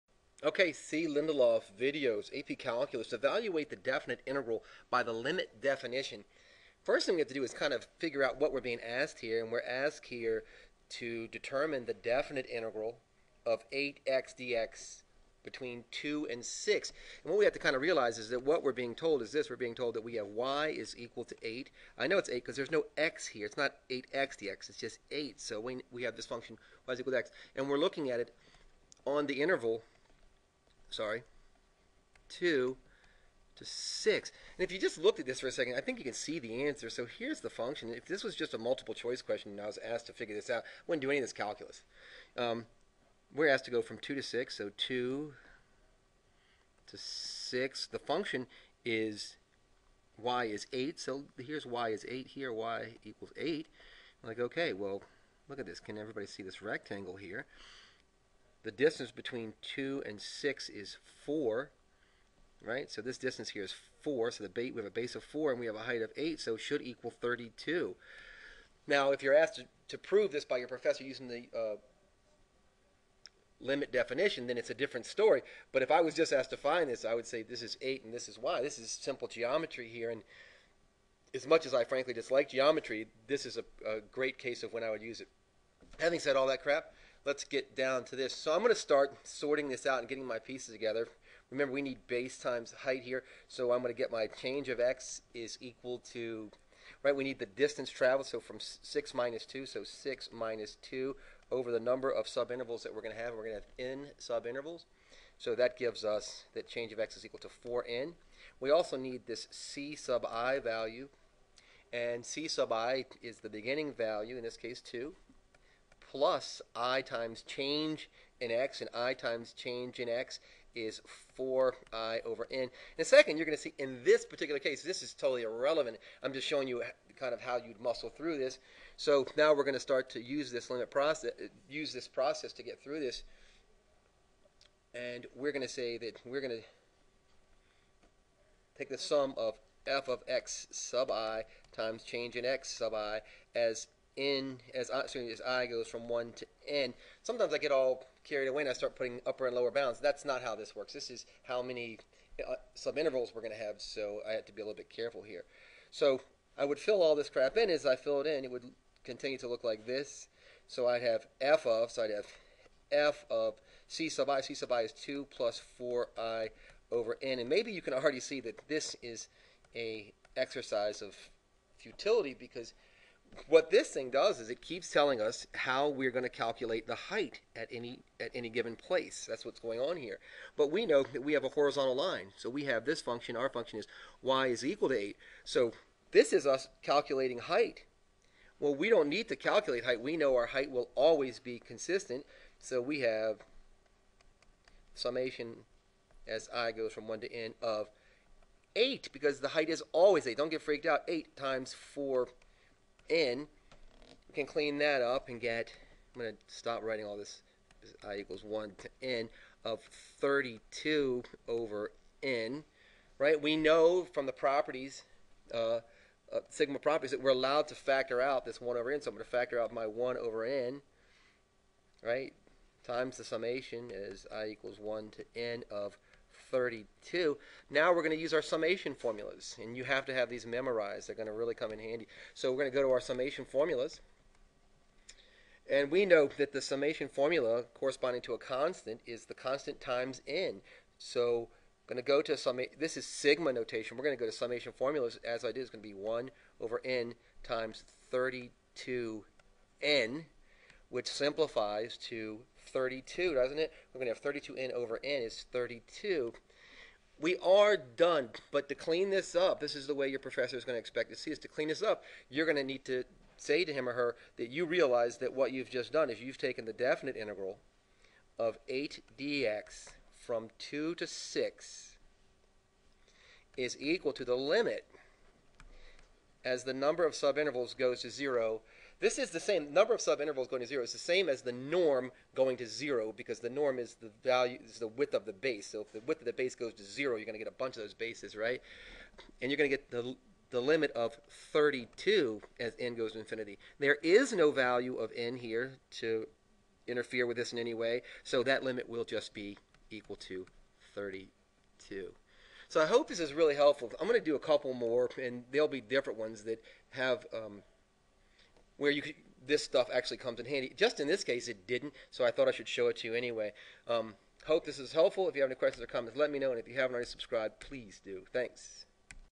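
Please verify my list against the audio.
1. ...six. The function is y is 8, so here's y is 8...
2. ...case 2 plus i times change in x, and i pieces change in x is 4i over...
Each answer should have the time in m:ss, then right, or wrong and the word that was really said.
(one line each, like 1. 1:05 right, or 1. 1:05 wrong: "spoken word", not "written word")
1. 0:46 right
2. 1:54 wrong: "times", not "pieces".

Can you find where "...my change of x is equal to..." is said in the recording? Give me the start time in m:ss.
1:34.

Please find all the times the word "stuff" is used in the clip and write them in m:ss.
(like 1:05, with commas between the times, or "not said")
5:09.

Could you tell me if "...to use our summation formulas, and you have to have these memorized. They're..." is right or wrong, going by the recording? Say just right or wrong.
right.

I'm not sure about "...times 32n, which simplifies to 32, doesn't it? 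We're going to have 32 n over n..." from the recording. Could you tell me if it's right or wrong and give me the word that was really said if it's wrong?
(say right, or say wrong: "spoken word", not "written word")
right.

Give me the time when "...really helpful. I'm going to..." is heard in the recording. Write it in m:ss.
5:03.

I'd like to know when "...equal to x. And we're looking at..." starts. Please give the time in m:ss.
0:26.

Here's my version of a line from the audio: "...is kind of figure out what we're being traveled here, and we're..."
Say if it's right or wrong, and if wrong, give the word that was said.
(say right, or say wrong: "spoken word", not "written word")
wrong: "asked", not "traveled".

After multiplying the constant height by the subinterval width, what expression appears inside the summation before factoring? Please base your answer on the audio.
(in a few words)
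32 over n.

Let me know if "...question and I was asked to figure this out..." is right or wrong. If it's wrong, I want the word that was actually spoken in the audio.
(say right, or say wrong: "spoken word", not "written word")
right.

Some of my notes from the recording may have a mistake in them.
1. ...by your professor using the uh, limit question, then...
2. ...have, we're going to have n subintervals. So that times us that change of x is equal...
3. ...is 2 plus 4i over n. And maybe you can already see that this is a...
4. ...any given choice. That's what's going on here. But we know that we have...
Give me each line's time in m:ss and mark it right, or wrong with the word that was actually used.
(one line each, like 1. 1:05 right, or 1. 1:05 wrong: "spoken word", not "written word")
1. 1:10 wrong: "definition", not "question"
2. 1:43 wrong: "gives", not "times"
3. 2:44 right
4. 2:58 wrong: "place", not "choice".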